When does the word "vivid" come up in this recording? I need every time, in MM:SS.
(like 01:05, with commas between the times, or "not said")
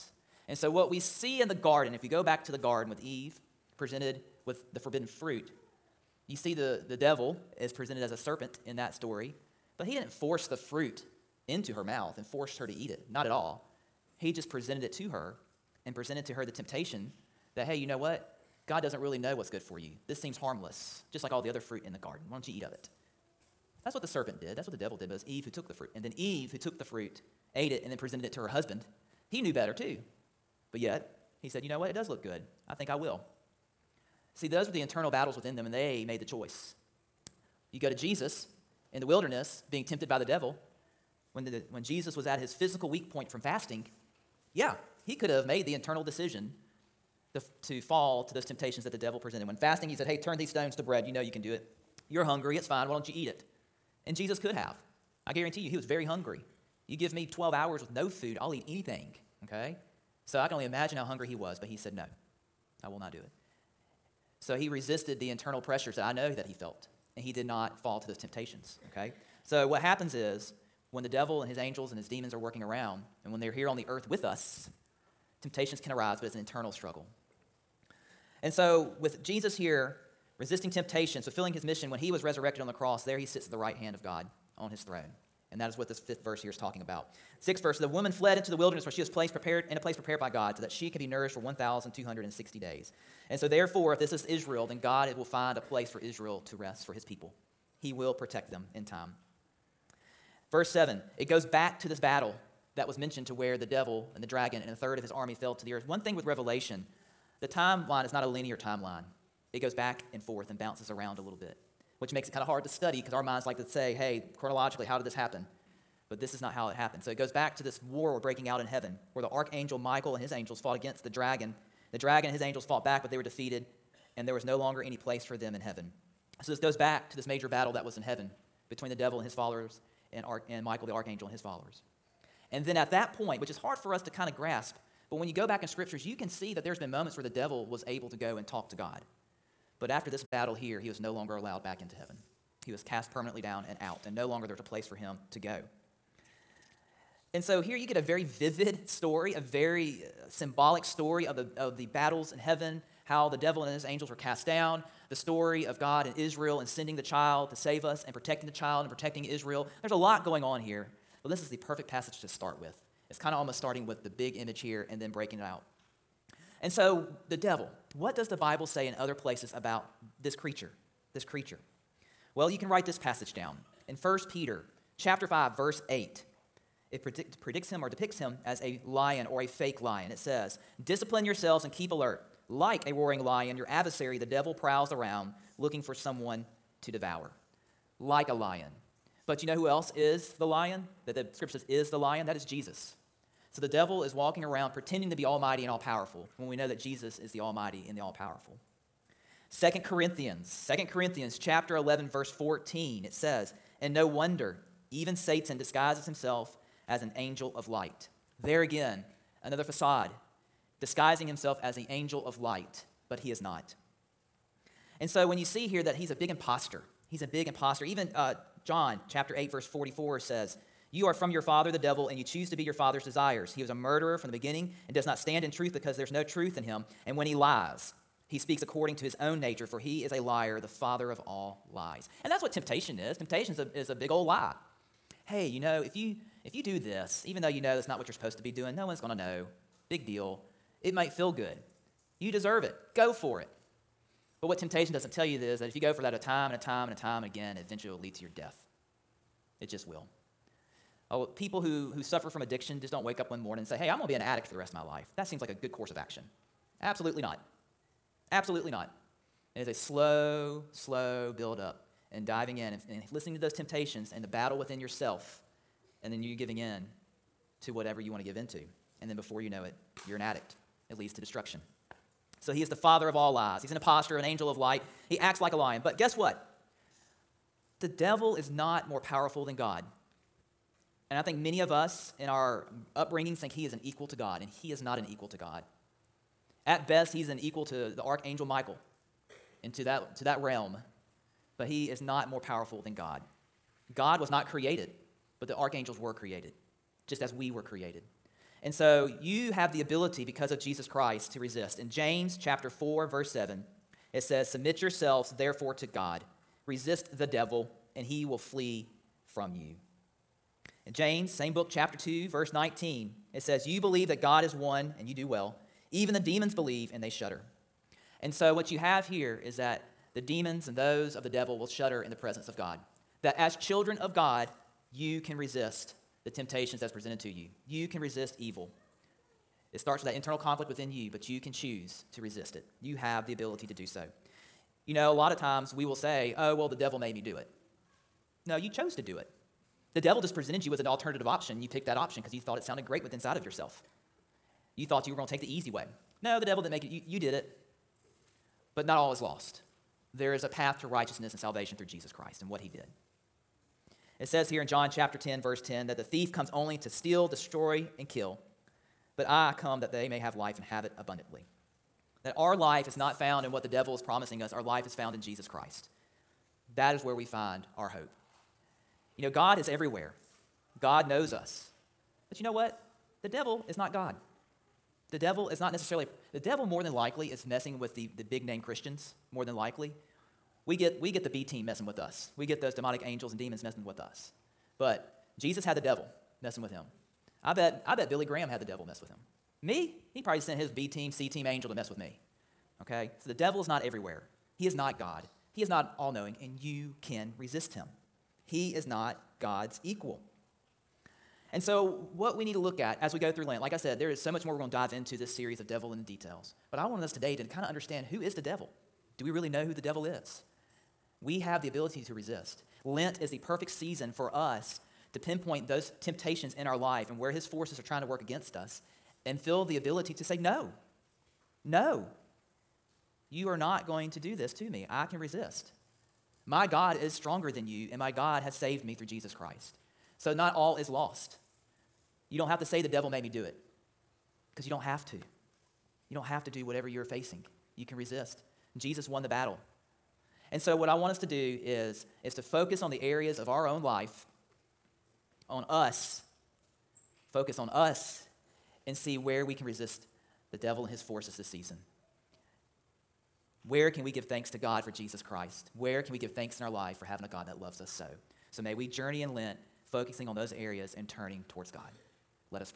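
02:28.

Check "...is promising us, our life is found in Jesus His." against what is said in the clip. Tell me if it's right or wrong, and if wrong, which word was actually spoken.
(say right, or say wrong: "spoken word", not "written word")
wrong: "Christ", not "His".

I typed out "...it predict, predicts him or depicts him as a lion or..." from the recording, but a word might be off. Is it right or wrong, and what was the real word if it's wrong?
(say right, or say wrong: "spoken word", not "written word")
right.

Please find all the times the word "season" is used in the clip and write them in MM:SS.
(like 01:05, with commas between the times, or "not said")
06:53, 07:31.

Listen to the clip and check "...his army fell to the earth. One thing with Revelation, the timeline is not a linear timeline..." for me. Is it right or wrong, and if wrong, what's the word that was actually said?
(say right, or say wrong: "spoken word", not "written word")
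right.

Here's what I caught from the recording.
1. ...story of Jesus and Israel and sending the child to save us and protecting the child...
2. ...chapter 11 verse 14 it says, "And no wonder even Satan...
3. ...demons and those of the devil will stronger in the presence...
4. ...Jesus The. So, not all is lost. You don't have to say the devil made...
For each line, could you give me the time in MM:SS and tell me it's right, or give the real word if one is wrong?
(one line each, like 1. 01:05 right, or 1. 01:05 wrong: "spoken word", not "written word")
1. 02:35 wrong: "God", not "Jesus"
2. 03:21 right
3. 05:20 wrong: "shudder", not "stronger"
4. 07:09 wrong: "Christ", not "The".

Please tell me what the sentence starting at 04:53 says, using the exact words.
God was not created, but the archangels were created, just as we were created.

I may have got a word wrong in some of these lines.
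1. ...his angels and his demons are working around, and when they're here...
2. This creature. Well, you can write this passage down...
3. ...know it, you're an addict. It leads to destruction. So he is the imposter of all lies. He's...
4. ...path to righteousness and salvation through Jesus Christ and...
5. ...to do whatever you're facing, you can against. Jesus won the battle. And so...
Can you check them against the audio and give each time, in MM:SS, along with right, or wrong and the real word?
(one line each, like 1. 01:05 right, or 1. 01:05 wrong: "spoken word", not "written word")
1. 01:11 right
2. 02:51 right
3. 04:29 wrong: "father", not "imposter"
4. 05:50 right
5. 07:16 wrong: "resist", not "against".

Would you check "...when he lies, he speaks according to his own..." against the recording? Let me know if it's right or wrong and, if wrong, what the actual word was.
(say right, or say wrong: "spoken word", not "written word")
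right.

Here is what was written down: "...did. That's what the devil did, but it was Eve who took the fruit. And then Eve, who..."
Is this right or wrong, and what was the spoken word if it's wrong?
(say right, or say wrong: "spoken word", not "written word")
right.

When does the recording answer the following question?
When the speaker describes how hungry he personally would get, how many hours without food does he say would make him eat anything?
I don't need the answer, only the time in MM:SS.
00:57.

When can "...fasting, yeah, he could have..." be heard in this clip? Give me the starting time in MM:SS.
00:43.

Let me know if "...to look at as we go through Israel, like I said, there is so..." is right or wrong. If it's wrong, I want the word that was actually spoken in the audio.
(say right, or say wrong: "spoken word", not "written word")
wrong: "Lent", not "Israel".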